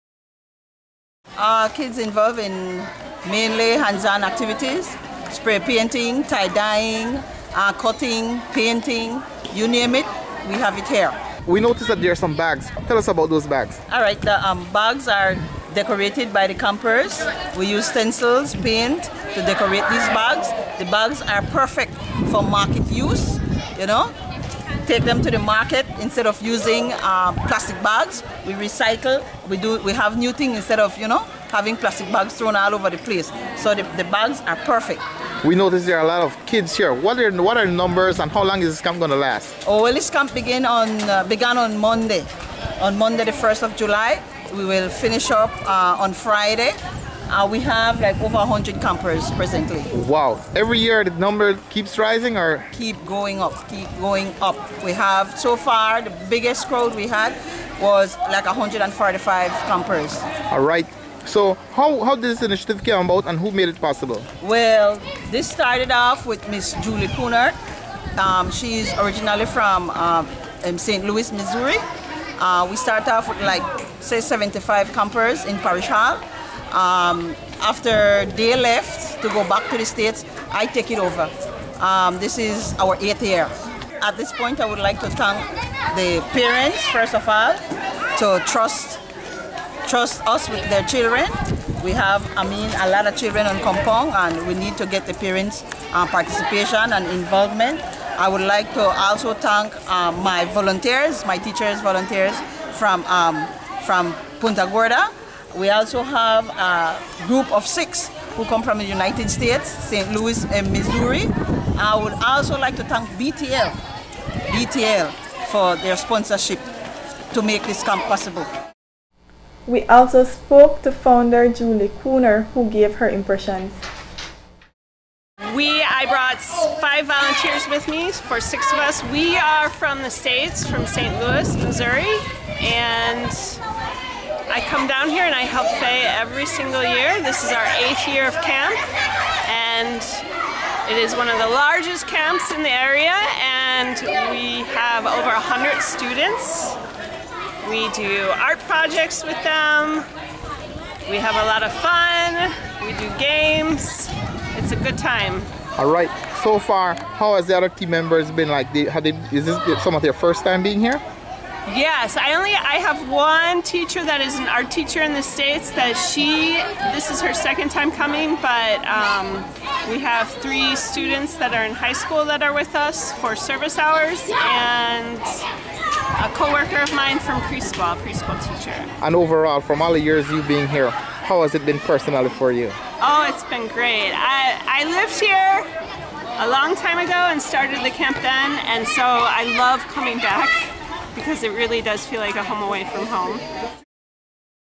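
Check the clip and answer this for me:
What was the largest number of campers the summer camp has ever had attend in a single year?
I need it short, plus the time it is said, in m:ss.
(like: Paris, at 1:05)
145, at 0:58.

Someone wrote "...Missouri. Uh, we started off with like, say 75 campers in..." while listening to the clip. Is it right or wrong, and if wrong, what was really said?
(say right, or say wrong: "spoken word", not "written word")
right.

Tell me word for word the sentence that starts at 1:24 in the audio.
At this point, I would like to thank the parents, first of all, to trust, trust us with their children.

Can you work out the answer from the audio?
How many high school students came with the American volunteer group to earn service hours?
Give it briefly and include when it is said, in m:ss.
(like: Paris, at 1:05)
3, at 2:50.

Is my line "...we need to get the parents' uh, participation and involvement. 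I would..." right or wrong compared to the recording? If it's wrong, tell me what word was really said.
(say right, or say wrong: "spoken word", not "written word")
right.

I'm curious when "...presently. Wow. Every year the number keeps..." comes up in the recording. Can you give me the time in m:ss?
0:49.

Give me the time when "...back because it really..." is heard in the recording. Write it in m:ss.
3:10.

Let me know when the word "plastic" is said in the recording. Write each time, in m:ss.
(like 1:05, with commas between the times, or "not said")
0:27, 0:31.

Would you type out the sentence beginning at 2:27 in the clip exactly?
We do art projects with them.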